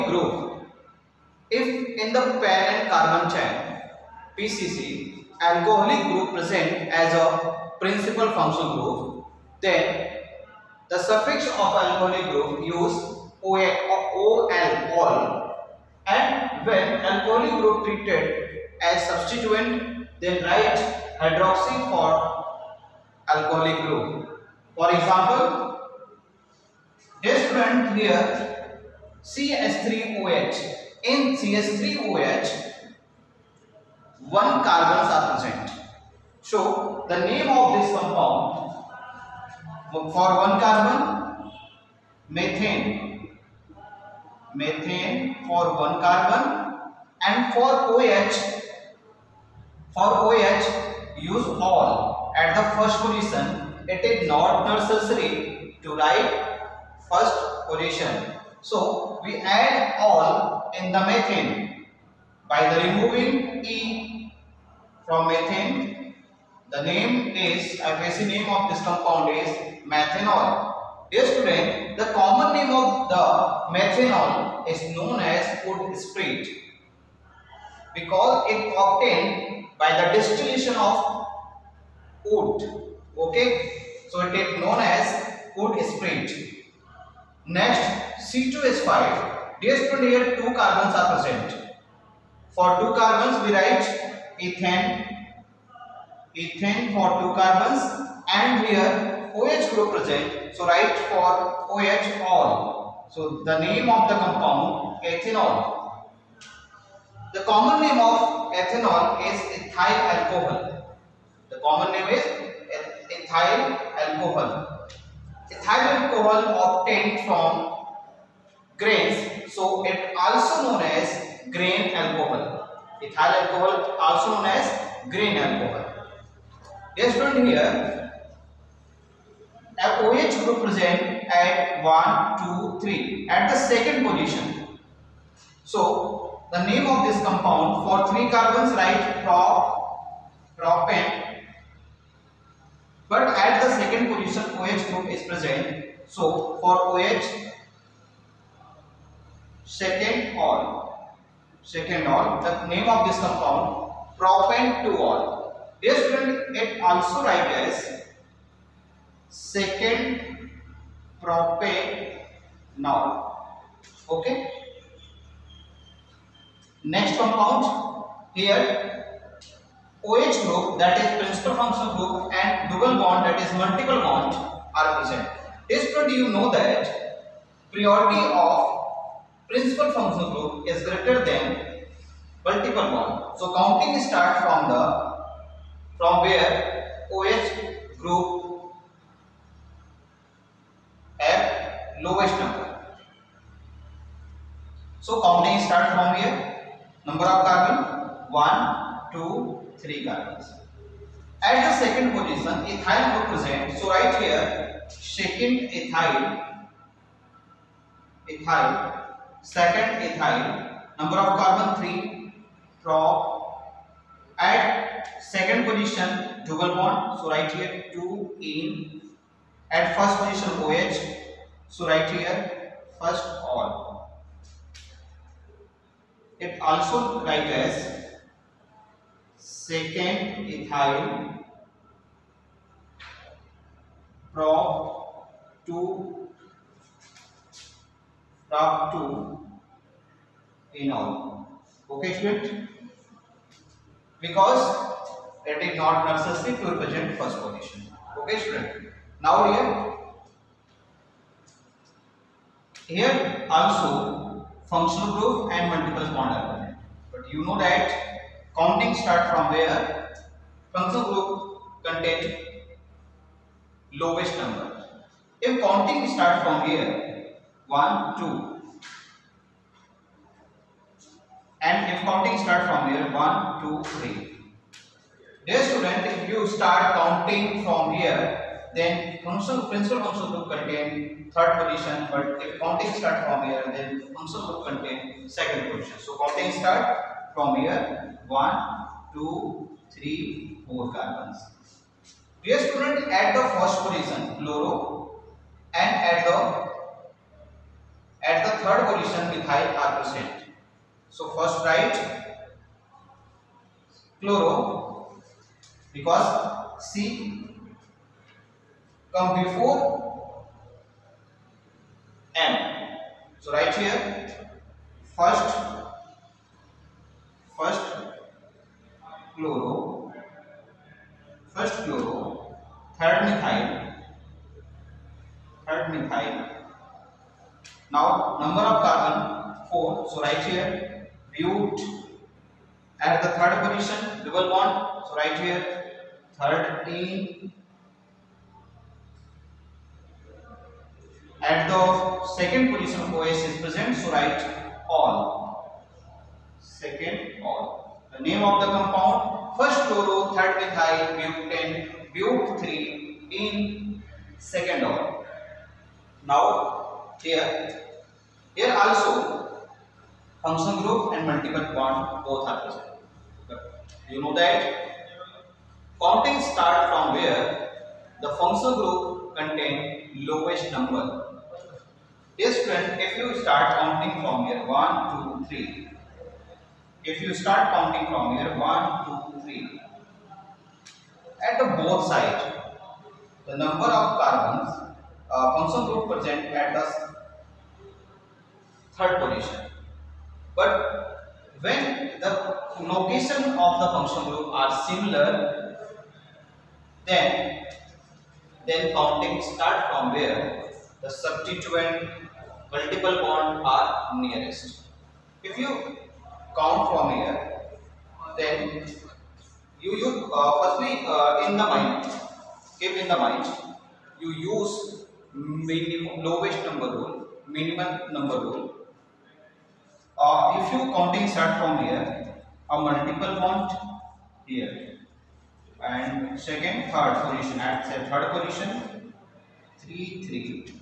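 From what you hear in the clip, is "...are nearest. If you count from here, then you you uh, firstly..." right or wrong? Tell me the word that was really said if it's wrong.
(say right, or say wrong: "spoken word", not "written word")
right.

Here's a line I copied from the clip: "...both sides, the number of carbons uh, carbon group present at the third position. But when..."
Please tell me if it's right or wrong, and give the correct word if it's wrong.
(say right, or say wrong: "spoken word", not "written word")
wrong: "function", not "carbon".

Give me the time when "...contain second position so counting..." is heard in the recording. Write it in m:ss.
4:44.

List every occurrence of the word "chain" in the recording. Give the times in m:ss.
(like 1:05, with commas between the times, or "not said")
0:03.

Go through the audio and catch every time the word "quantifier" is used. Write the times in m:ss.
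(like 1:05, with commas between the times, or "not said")
4:16.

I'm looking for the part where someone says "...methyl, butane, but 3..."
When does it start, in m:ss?
5:50.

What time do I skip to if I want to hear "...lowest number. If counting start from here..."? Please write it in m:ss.
4:23.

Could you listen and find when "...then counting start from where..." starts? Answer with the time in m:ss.
6:38.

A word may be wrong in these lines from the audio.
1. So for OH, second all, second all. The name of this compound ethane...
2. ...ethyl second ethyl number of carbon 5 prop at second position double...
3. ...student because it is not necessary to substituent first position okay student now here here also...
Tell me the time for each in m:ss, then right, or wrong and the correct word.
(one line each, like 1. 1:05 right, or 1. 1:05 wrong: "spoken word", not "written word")
1. 2:26 wrong: "propane", not "ethane"
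2. 3:28 wrong: "3", not "5"
3. 4:02 wrong: "represent", not "substituent".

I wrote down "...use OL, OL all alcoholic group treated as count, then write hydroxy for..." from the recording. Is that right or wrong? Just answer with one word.
wrong.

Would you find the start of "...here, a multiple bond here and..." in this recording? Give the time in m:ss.
7:01.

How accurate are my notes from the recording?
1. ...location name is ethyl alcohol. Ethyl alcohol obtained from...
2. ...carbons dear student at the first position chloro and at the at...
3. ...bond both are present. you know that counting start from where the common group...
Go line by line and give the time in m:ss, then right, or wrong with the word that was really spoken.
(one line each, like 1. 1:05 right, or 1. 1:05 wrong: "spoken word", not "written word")
1. 1:51 wrong: "common", not "location"
2. 4:50 right
3. 6:01 wrong: "function", not "common".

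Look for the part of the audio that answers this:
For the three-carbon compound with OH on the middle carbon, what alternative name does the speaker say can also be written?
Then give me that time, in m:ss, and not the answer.
2:39.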